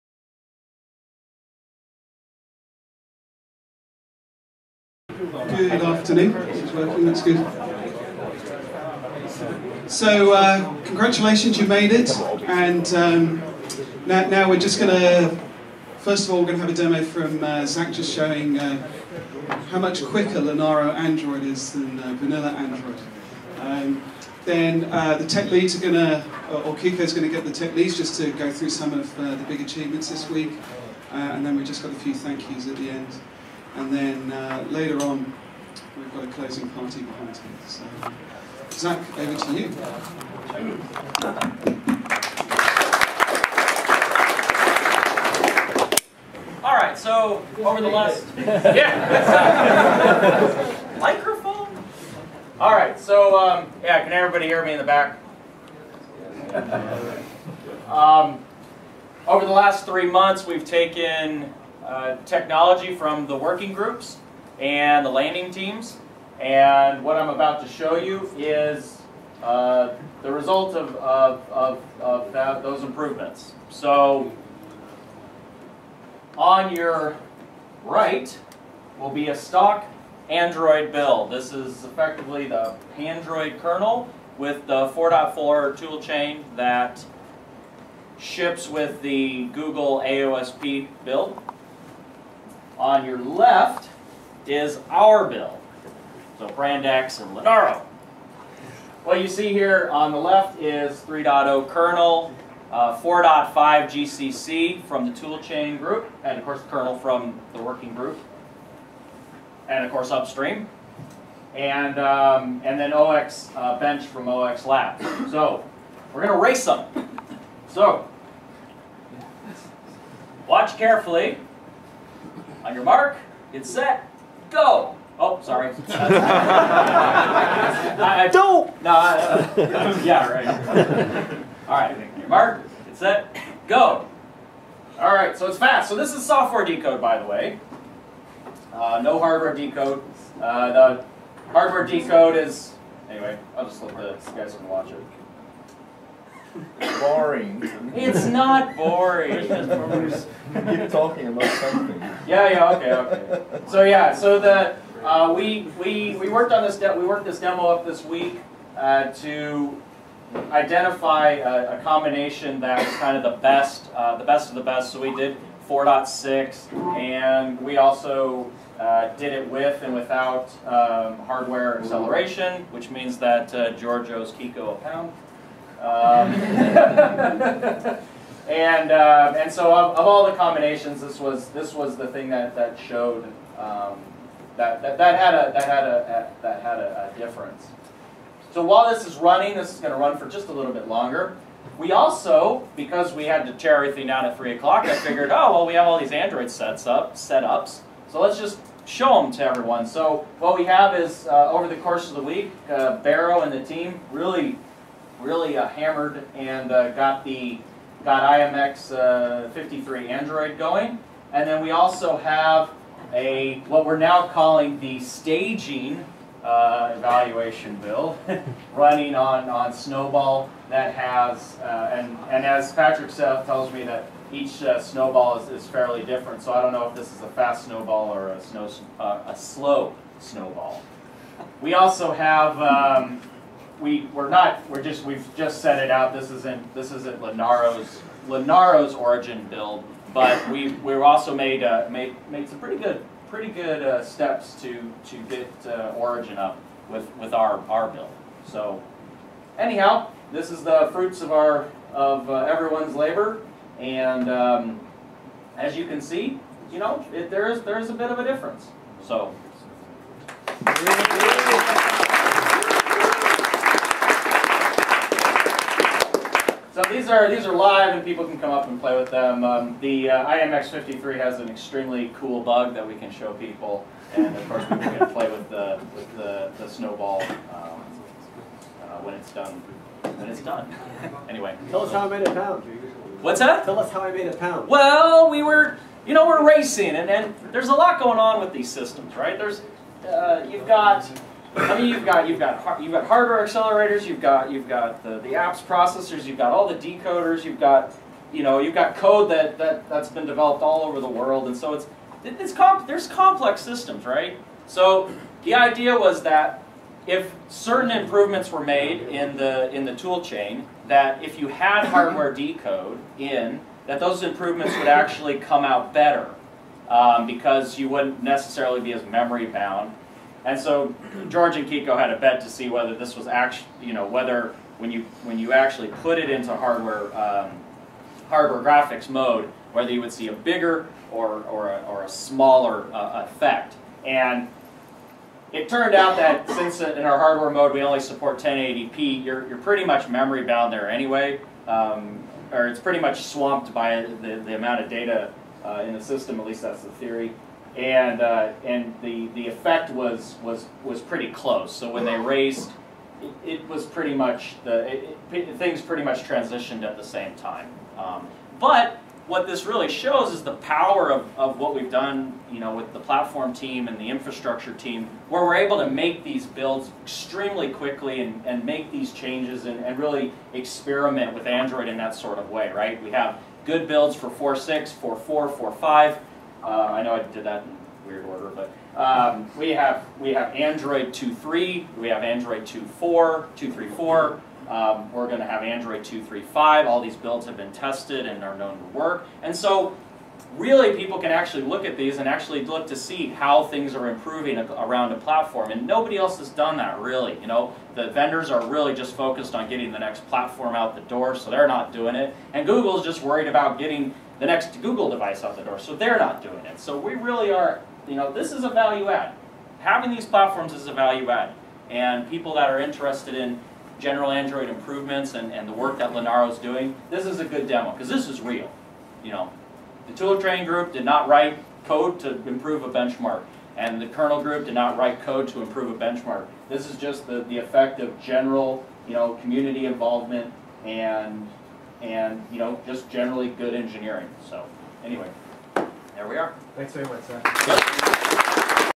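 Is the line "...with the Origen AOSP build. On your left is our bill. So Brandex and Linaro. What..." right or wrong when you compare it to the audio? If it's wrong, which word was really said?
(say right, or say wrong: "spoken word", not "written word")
wrong: "Google", not "Origen".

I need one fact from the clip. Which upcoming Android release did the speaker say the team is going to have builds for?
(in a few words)
Android 2.3.5.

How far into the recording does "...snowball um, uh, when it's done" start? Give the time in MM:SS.
04:36.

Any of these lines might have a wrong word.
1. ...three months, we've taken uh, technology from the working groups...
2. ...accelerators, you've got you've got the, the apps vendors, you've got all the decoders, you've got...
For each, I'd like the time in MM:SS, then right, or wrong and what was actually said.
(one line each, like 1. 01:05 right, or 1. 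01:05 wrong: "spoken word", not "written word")
1. 00:59 right
2. 04:53 wrong: "processors", not "vendors".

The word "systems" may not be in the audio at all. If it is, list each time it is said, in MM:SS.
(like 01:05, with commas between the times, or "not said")
04:48, 05:03, 05:46.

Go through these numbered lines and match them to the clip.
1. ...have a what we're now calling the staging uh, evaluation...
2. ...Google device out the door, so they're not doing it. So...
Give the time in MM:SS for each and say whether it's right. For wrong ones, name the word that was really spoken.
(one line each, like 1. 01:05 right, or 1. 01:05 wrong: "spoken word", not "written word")
1. 03:32 right
2. 06:44 right.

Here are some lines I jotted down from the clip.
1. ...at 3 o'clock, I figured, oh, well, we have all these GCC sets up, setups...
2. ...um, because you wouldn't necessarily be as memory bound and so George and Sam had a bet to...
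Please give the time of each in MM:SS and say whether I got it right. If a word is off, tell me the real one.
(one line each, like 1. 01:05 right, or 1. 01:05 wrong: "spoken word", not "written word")
1. 03:14 wrong: "Android", not "GCC"
2. 05:16 wrong: "Kiko", not "Sam".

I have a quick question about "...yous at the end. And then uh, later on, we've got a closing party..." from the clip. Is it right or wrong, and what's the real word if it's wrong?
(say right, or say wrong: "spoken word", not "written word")
right.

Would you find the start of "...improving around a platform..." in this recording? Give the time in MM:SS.
06:34.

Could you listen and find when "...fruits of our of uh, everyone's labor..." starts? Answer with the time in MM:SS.
04:10.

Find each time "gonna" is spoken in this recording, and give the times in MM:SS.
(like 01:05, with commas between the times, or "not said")
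01:56.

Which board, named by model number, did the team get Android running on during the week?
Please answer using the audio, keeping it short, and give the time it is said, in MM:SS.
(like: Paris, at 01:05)
IMX53, at 03:28.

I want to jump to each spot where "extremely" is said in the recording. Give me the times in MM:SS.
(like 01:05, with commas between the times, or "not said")
04:31, 06:07.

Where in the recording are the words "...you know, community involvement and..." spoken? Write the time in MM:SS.
07:09.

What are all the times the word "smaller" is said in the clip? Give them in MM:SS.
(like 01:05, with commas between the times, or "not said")
05:32.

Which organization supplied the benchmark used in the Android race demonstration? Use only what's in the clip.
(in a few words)
0xlab.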